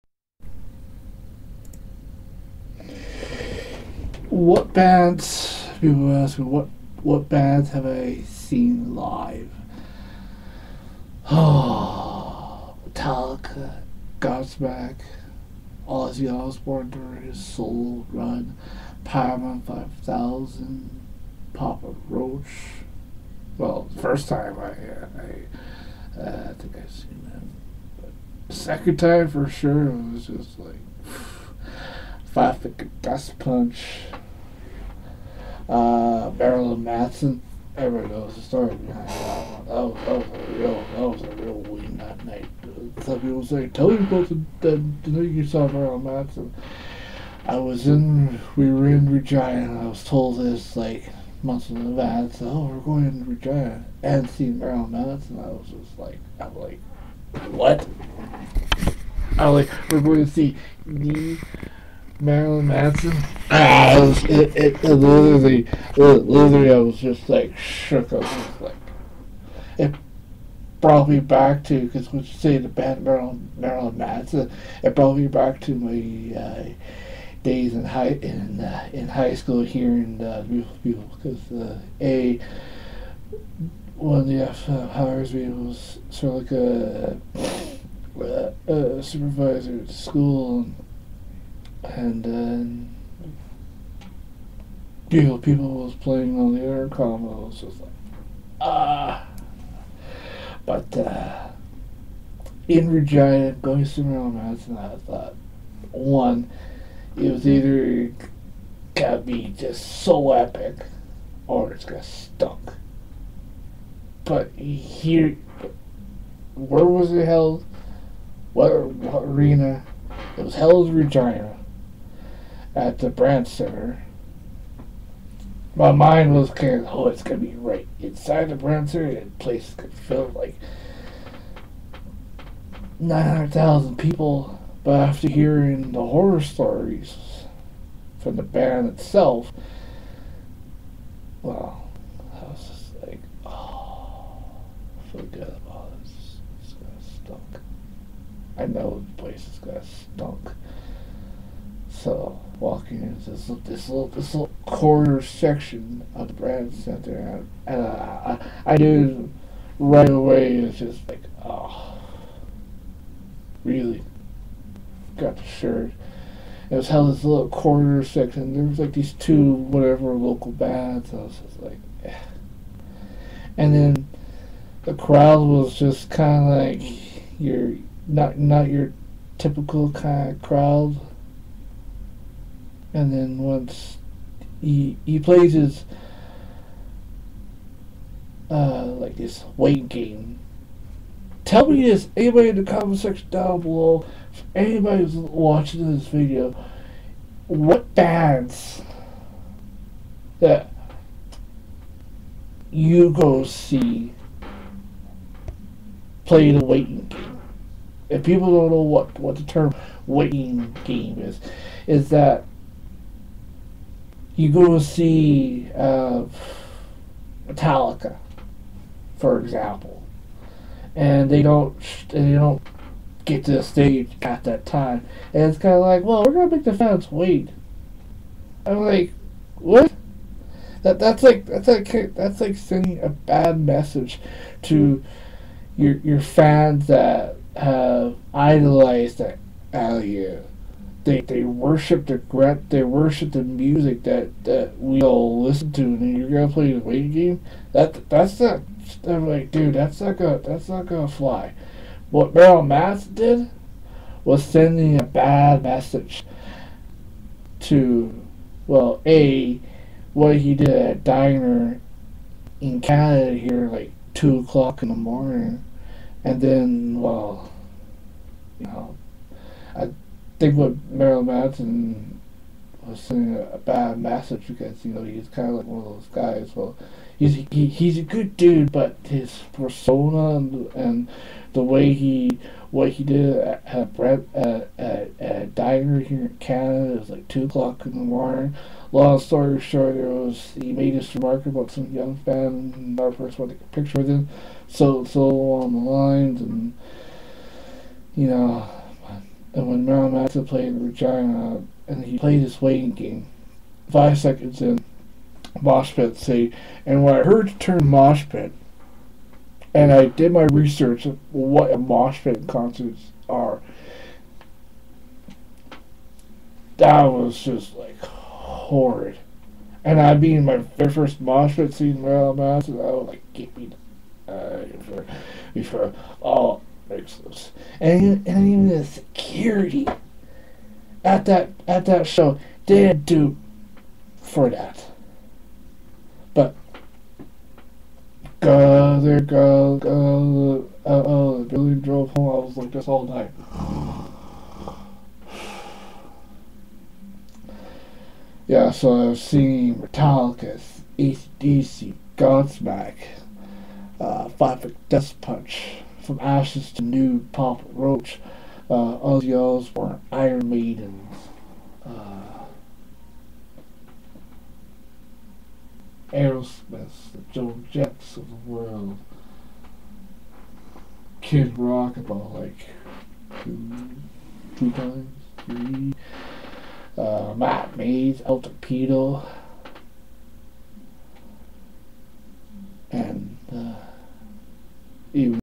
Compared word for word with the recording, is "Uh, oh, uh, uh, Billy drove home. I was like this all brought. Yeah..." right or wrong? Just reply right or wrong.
wrong.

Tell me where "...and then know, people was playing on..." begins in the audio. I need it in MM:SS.
01:31.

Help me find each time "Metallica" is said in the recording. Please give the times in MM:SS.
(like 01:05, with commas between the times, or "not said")
00:12, 03:37, 05:49.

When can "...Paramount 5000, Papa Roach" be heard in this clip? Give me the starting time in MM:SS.
00:19.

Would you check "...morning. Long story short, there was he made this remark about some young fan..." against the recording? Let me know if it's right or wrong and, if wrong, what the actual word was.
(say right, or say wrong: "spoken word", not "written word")
right.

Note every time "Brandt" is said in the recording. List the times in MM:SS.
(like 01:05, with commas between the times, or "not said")
02:03, 02:08, 02:36.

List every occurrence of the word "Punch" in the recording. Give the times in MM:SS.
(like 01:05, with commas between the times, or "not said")
00:33, 05:55.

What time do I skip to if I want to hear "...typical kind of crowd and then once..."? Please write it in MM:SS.
02:59.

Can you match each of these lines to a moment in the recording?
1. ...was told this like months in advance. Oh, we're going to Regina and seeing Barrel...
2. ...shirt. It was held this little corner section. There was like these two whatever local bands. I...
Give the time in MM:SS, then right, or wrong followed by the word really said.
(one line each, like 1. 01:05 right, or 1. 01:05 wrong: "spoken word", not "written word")
1. 00:49 right
2. 02:45 right.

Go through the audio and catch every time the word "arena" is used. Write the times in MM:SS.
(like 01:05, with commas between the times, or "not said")
01:58.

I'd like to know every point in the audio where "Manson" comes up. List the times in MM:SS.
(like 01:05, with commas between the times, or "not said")
01:02, 01:13, 04:12, 04:31, 05:00, 05:22.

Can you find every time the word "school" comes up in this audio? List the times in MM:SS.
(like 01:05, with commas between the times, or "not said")
01:19, 01:29.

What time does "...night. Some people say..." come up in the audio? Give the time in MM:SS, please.
00:42.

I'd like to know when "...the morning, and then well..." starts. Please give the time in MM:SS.
04:24.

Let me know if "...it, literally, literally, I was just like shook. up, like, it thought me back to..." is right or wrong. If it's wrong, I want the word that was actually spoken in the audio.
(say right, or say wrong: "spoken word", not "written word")
wrong: "brought", not "thought".